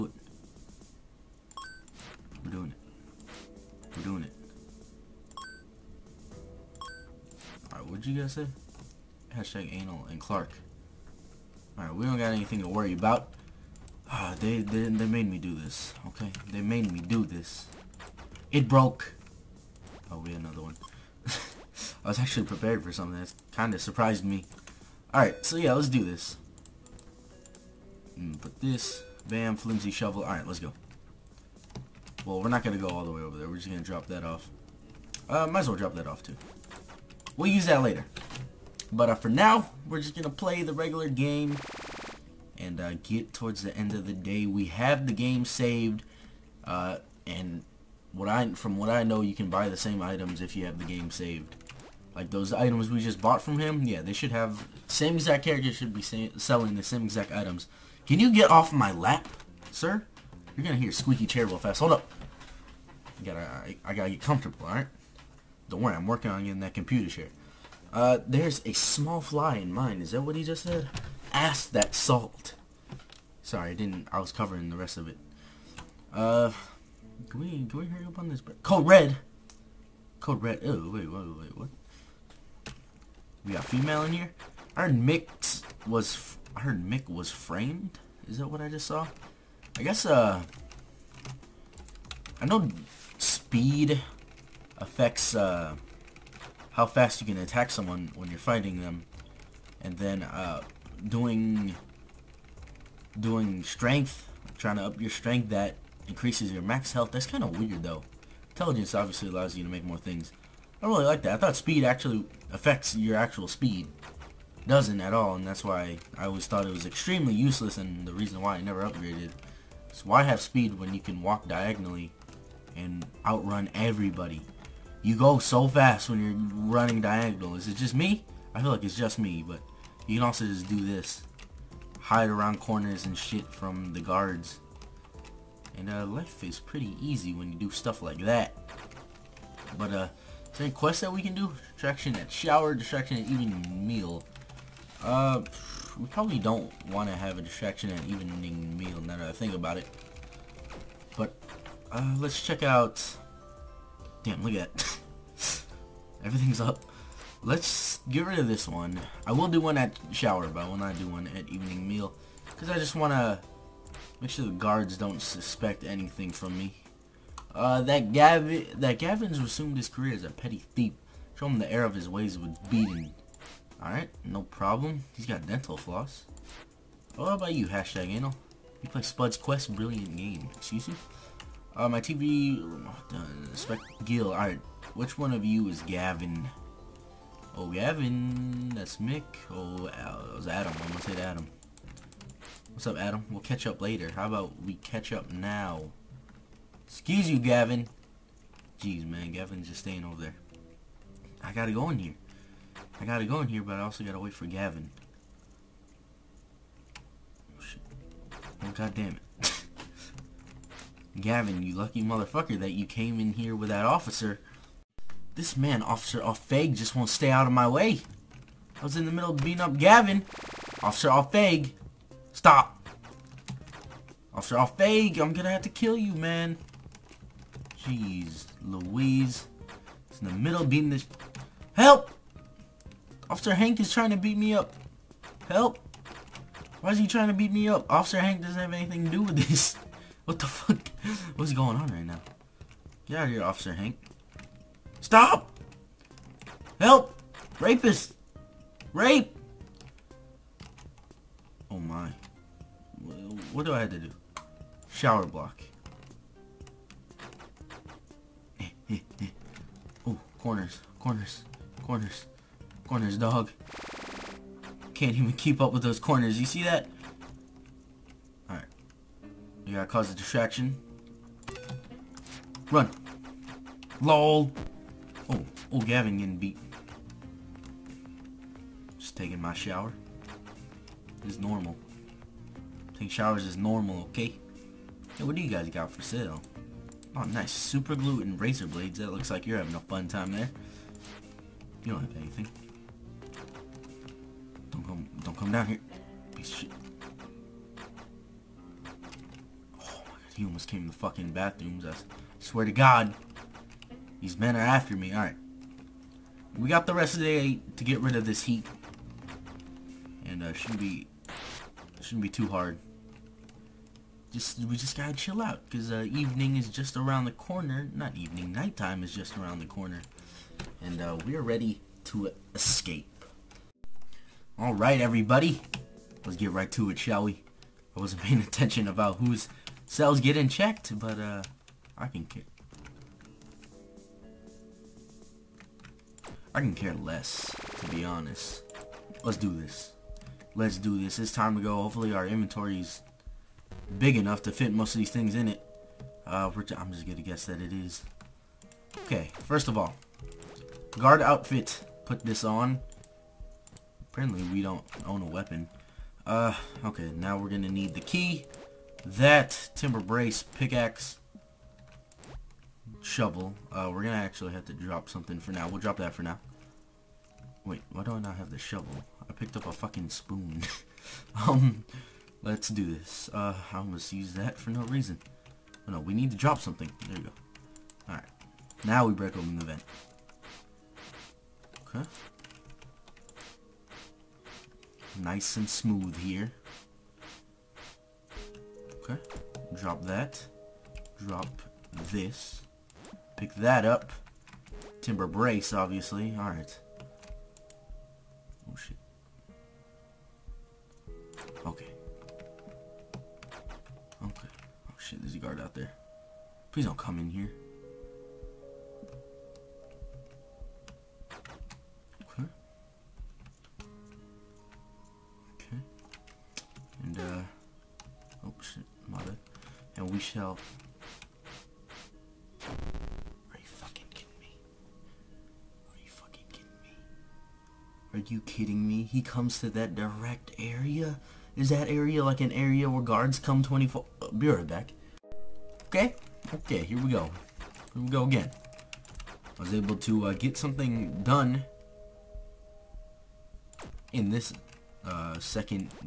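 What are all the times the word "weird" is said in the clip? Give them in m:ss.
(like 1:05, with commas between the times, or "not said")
1:47.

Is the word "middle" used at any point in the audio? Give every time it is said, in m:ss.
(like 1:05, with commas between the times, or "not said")
3:39, 3:50.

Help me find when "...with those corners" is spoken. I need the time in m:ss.
4:25.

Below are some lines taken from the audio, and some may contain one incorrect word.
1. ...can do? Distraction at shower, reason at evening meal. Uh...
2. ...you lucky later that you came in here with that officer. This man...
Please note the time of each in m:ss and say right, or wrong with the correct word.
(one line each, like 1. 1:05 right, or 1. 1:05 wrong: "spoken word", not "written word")
1. 2:21 wrong: "distraction", not "reason"
2. 3:31 wrong: "motherfucker", not "later".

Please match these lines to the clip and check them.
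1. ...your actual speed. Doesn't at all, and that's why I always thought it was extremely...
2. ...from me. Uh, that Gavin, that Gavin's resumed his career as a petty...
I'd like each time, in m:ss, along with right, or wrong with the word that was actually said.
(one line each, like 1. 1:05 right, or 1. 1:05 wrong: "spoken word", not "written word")
1. 1:52 right
2. 2:46 right.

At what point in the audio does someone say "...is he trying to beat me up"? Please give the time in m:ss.
3:56.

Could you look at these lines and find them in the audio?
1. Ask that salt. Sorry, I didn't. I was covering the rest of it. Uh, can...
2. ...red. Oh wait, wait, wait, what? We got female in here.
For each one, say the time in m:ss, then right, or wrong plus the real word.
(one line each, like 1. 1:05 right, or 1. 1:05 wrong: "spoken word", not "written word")
1. 1:11 right
2. 1:20 right.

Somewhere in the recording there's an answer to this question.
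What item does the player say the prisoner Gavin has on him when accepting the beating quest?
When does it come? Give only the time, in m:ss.
2:55.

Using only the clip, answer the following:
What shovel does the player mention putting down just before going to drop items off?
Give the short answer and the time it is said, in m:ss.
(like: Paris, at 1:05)
Flimsy shovel, at 0:29.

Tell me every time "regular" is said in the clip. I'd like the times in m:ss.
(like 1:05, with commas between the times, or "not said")
0:40.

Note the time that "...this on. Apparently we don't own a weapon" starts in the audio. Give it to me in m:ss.
5:52.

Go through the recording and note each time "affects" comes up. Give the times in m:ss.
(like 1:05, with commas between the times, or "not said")
1:34, 1:52.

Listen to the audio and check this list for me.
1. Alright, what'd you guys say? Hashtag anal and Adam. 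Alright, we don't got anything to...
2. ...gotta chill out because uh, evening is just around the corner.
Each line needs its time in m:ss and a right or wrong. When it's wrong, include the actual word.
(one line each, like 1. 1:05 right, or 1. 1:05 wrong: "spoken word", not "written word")
1. 0:07 wrong: "Clark", not "Adam"
2. 5:14 right.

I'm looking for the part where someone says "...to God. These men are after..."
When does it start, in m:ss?
5:02.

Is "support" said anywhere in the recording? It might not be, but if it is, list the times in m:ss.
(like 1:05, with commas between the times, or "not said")
not said.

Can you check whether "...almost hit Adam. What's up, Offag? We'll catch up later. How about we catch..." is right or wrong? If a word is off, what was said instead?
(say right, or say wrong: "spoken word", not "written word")
wrong: "Adam", not "Offag".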